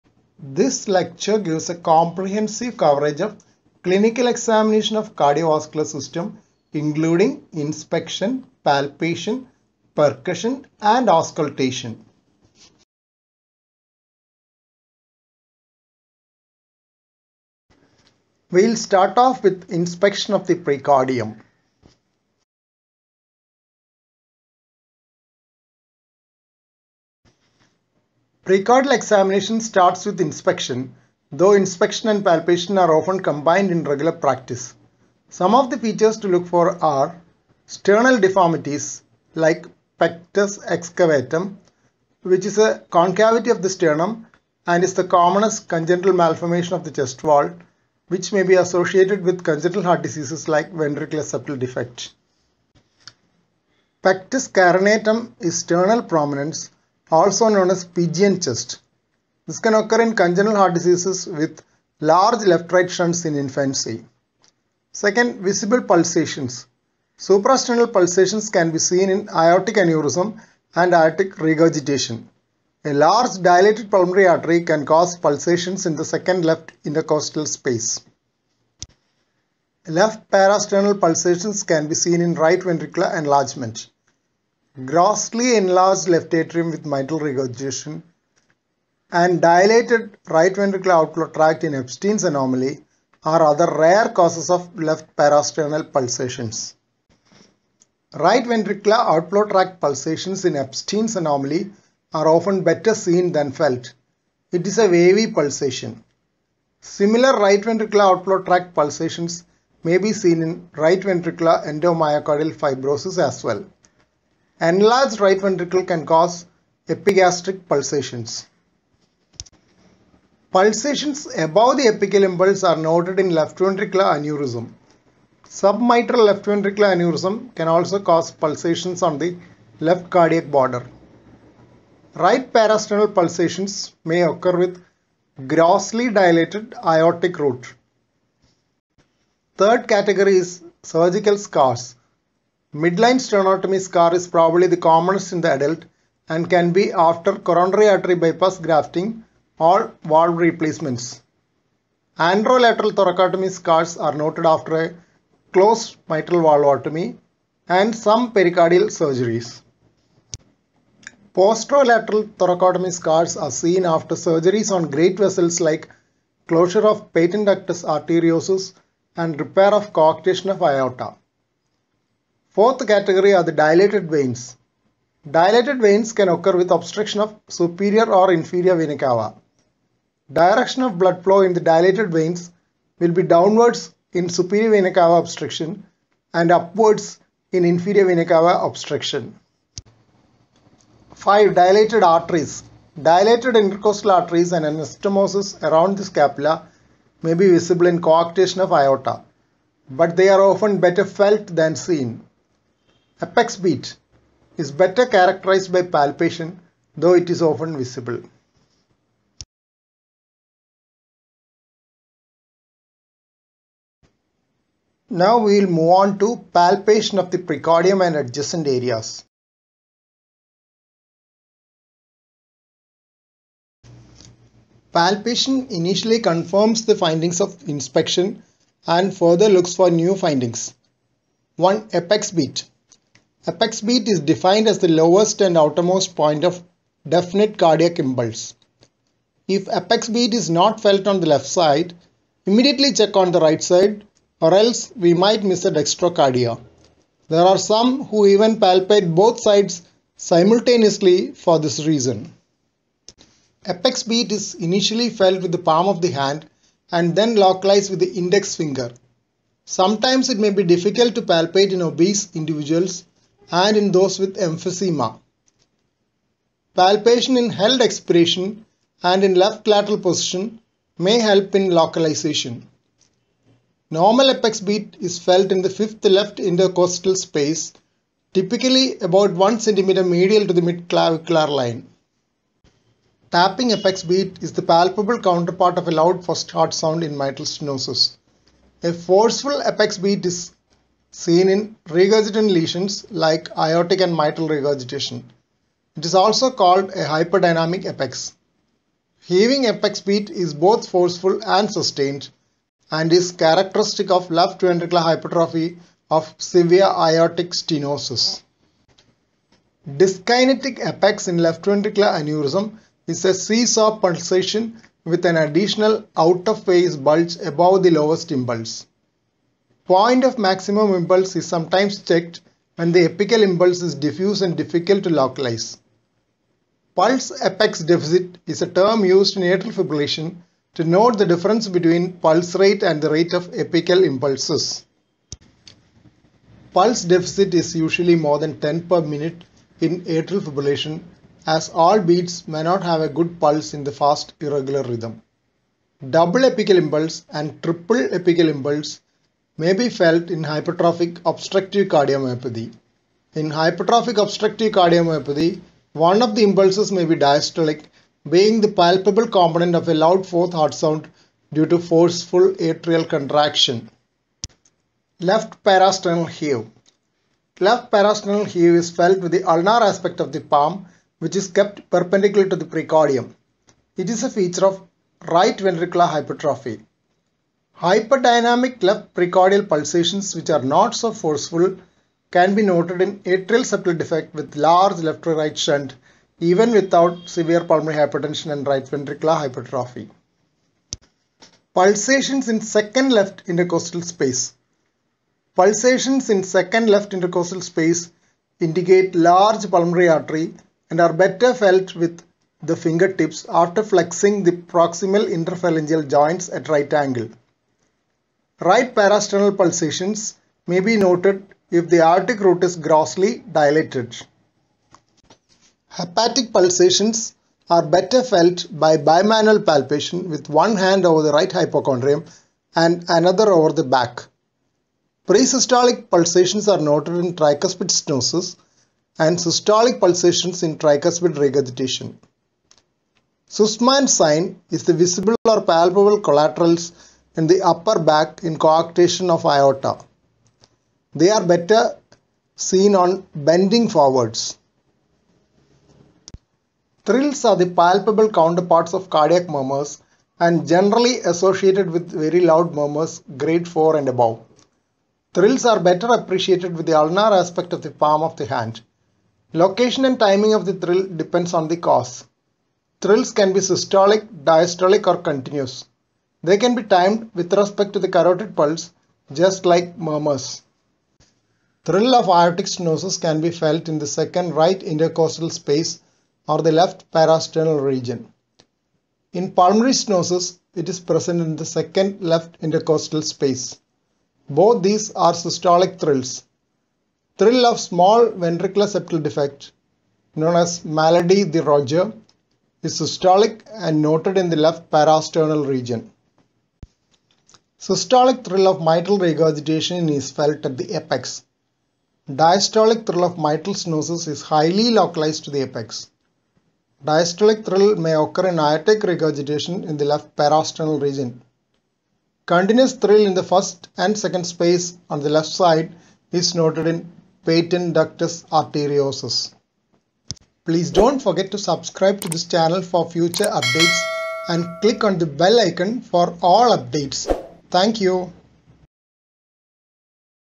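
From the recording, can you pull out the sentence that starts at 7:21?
They are better seen on bending forwards.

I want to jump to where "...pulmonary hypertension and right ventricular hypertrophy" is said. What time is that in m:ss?
6:27.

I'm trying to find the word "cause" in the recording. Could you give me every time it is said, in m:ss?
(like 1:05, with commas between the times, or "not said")
1:14, 1:34, 1:56, 2:08, 7:41.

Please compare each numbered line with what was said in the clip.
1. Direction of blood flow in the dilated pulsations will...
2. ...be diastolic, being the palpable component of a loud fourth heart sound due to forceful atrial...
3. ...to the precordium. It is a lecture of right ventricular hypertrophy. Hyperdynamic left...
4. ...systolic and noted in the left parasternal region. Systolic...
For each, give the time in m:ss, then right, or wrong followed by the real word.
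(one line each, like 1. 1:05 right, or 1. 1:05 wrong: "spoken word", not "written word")
1. 3:00 wrong: "veins", not "pulsations"
2. 5:57 right
3. 6:12 wrong: "feature", not "lecture"
4. 8:12 right.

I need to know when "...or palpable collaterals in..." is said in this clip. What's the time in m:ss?
7:15.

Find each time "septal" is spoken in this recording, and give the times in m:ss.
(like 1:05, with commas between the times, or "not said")
0:51, 6:23, 8:08.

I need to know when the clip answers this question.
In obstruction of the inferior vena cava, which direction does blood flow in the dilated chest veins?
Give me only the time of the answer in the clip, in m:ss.
3:06.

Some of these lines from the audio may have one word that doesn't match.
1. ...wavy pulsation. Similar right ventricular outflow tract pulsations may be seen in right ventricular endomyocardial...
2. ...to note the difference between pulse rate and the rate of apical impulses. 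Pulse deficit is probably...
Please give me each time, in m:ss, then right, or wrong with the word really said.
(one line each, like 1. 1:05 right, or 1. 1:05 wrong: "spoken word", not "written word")
1. 1:44 right
2. 5:30 wrong: "usually", not "probably".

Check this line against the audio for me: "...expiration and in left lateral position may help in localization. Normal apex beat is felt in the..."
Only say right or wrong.
right.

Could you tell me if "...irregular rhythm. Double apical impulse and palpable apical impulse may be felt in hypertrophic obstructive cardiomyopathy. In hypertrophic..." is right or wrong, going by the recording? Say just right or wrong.
wrong.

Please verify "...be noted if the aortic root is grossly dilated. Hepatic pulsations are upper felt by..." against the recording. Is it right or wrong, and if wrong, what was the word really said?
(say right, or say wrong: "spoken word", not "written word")
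wrong: "better", not "upper".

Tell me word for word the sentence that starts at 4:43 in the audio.
Tapping apex beat is the palpable counterpart of a loud first heart sound in mitral stenosis.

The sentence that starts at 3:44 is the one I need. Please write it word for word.
Palpation initially confirms the findings of inspection and further looks for new findings.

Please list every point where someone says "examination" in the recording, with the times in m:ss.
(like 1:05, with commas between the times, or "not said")
0:04, 0:28.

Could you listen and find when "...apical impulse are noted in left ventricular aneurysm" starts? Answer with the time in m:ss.
2:01.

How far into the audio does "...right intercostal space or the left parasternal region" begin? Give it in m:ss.
7:54.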